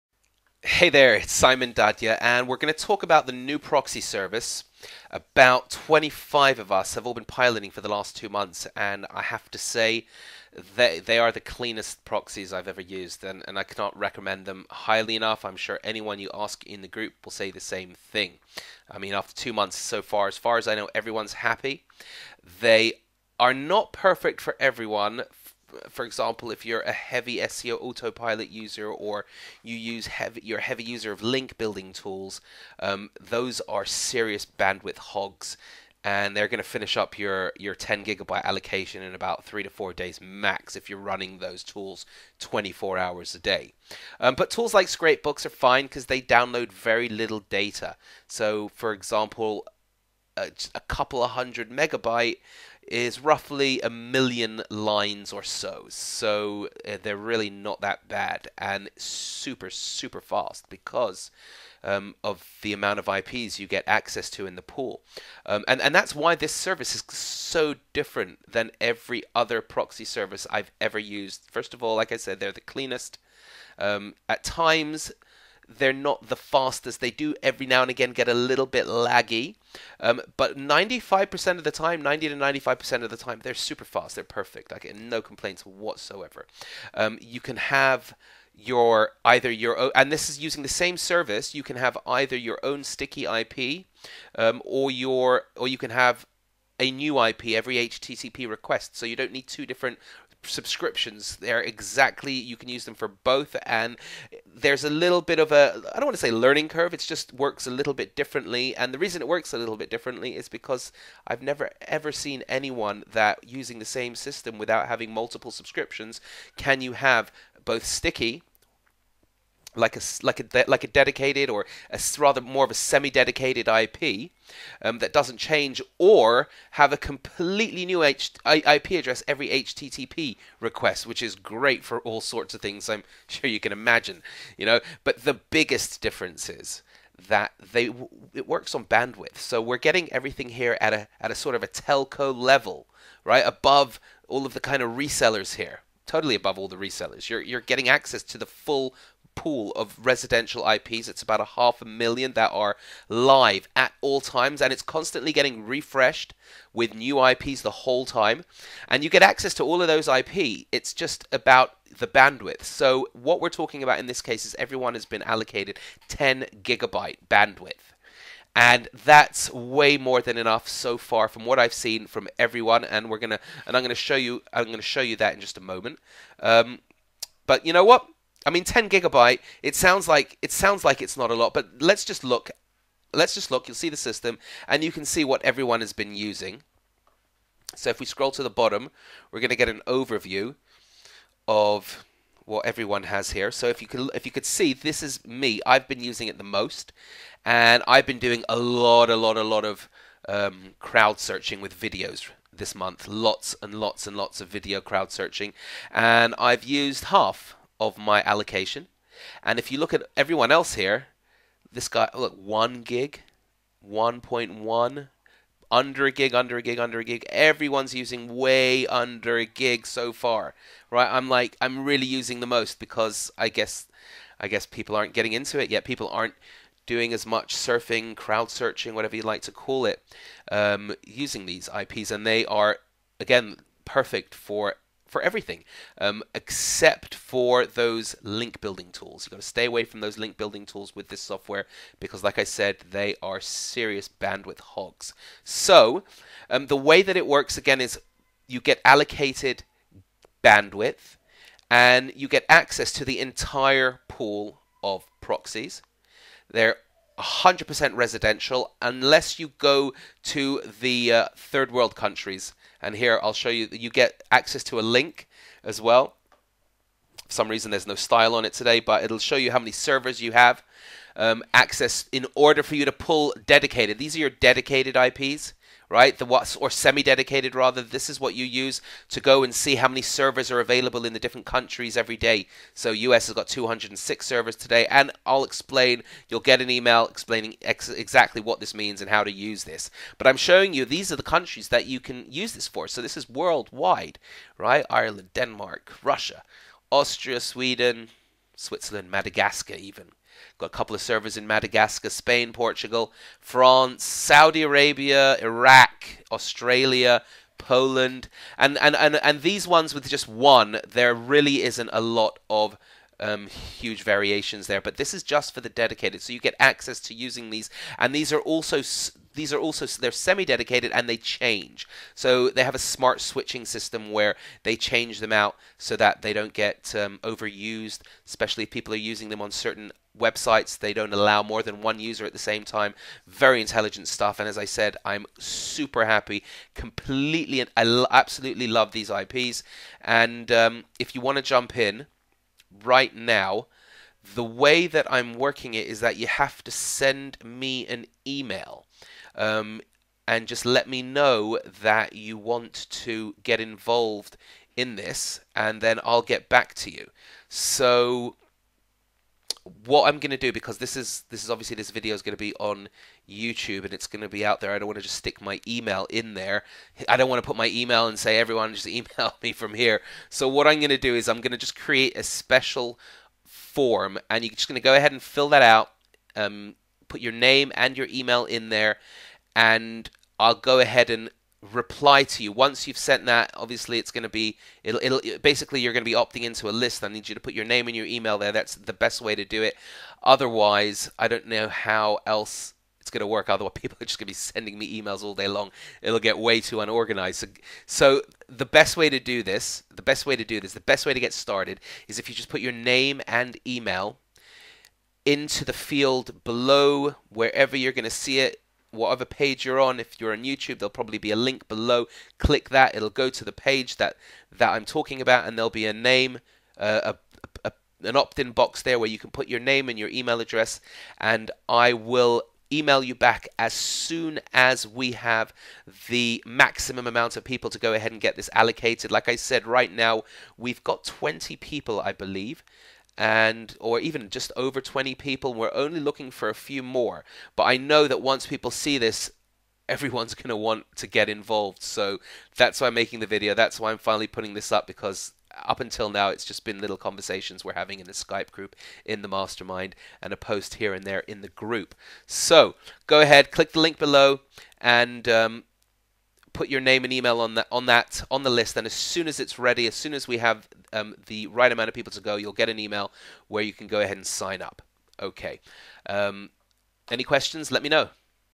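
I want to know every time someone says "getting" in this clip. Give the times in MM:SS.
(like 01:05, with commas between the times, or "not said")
02:19, 02:27, 02:35, 03:45.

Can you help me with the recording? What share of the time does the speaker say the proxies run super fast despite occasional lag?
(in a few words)
90 to 95%.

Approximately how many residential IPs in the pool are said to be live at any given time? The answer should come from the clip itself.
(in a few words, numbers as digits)
half a million.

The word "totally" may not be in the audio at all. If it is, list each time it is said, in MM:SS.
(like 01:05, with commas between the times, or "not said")
02:26.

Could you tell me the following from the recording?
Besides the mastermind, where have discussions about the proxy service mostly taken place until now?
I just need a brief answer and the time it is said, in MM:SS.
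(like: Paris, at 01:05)
Skype group, at 07:28.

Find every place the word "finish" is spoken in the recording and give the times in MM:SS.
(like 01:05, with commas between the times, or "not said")
00:36.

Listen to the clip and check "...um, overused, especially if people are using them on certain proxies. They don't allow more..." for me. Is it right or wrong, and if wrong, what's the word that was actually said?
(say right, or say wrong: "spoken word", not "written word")
wrong: "websites", not "proxies".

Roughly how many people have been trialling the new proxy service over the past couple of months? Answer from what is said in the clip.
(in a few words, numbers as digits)
25.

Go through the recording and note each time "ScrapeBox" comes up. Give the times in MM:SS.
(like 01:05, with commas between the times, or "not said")
00:44.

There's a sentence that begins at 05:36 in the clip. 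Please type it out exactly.
Completely, I absolutely love these IPs.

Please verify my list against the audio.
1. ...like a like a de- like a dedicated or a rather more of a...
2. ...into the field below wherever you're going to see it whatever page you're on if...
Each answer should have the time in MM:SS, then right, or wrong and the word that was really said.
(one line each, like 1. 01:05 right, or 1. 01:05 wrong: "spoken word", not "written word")
1. 01:59 right
2. 06:45 right.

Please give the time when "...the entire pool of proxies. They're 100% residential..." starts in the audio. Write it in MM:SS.
04:13.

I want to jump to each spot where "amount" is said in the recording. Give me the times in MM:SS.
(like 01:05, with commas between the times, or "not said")
01:02, 07:07, 07:41.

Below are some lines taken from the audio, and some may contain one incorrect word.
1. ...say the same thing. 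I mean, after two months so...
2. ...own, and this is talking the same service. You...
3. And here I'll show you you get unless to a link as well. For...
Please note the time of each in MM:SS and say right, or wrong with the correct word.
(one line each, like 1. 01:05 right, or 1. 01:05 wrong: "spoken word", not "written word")
1. 00:17 right
2. 01:29 wrong: "using", not "talking"
3. 04:22 wrong: "access", not "unless".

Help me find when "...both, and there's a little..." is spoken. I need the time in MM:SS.
01:43.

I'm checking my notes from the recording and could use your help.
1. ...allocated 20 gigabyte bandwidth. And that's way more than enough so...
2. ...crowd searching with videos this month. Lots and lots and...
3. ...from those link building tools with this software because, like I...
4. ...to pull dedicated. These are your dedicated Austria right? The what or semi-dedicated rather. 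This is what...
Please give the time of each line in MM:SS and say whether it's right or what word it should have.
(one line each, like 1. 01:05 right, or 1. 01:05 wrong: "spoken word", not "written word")
1. 02:45 wrong: "10", not "20"
2. 03:20 right
3. 03:59 right
4. 04:32 wrong: "IPs", not "Austria".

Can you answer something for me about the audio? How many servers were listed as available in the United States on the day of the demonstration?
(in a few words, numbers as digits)
206.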